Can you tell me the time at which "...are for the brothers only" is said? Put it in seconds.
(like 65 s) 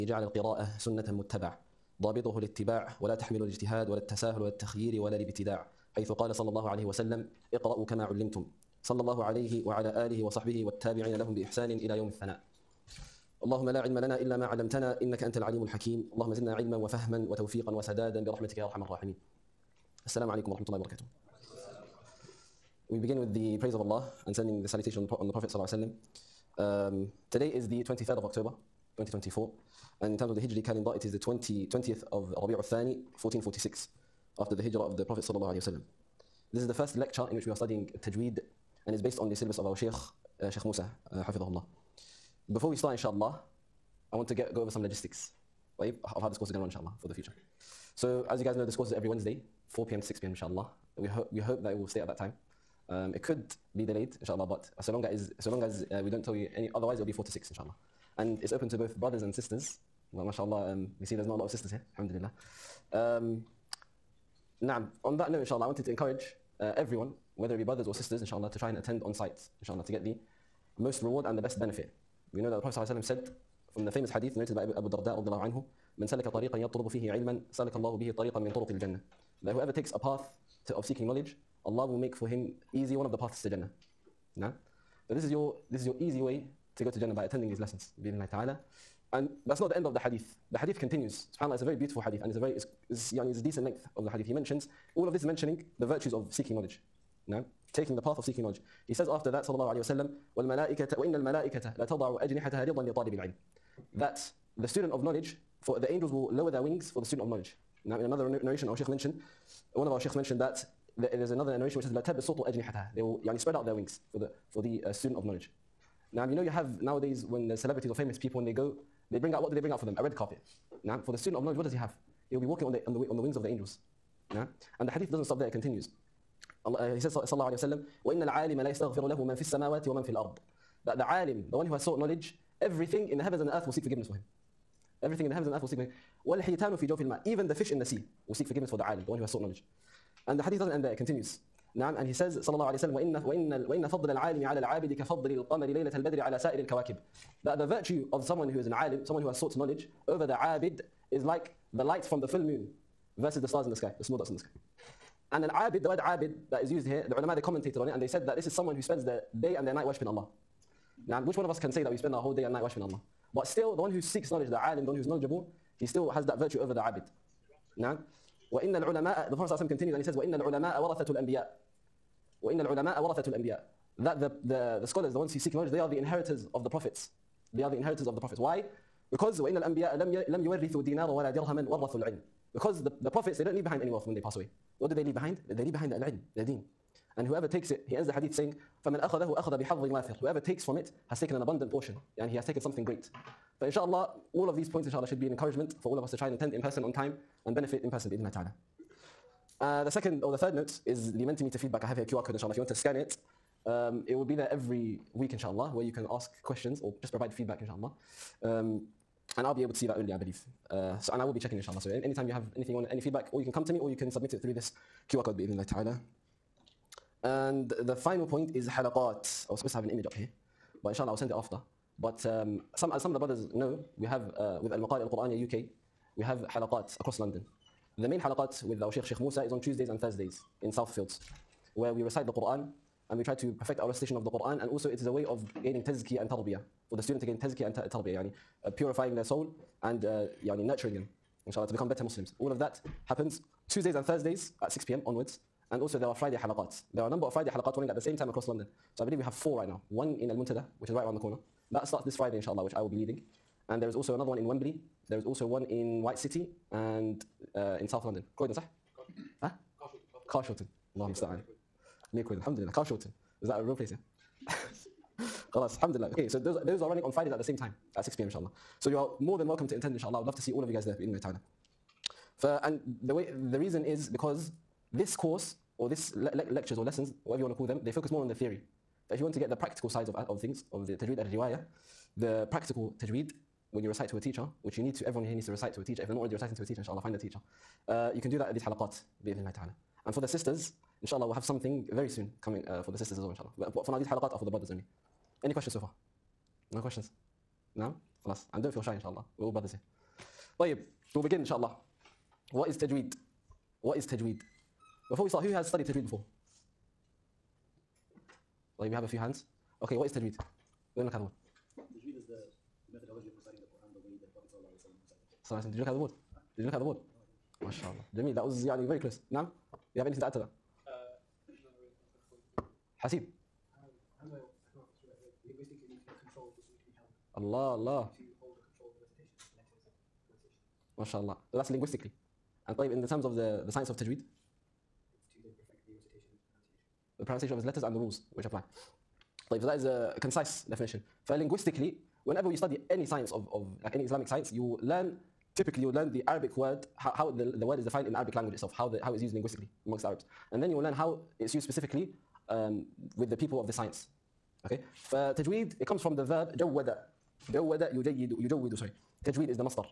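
294 s.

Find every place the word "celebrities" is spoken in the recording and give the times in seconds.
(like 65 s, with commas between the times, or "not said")
117 s.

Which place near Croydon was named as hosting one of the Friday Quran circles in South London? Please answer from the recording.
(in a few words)
Carshalton.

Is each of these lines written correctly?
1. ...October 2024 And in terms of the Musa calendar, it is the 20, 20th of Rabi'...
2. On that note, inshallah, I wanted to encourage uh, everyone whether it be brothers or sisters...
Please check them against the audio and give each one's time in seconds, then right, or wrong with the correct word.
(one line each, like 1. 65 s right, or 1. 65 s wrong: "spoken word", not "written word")
1. 28 s wrong: "Hijri", not "Musa"
2. 65 s right.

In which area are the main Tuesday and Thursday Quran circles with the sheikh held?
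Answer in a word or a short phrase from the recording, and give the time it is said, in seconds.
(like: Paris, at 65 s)
Southfields, at 230 s.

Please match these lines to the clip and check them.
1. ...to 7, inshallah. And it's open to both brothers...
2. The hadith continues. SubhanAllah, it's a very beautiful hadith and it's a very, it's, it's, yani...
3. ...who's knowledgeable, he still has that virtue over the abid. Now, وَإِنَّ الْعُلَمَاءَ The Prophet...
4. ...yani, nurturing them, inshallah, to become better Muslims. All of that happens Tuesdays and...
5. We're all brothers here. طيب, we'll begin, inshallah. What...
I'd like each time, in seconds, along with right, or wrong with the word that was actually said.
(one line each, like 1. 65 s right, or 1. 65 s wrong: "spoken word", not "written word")
1. 57 s wrong: "6", not "7"
2. 90 s right
3. 164 s right
4. 240 s right
5. 299 s right.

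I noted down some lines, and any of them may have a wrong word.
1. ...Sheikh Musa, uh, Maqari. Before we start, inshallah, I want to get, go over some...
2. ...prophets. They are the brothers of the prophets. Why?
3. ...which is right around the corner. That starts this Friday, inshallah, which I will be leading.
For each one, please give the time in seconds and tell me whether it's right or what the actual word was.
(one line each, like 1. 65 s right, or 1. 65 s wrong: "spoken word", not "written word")
1. 40 s wrong: "Hafidhahullah", not "Maqari"
2. 176 s wrong: "inheritors", not "brothers"
3. 250 s right.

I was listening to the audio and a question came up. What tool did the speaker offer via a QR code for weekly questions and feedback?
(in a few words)
Mentimeter.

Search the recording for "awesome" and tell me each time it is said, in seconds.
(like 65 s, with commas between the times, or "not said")
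not said.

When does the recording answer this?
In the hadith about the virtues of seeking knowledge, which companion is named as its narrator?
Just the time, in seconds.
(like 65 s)
74 s.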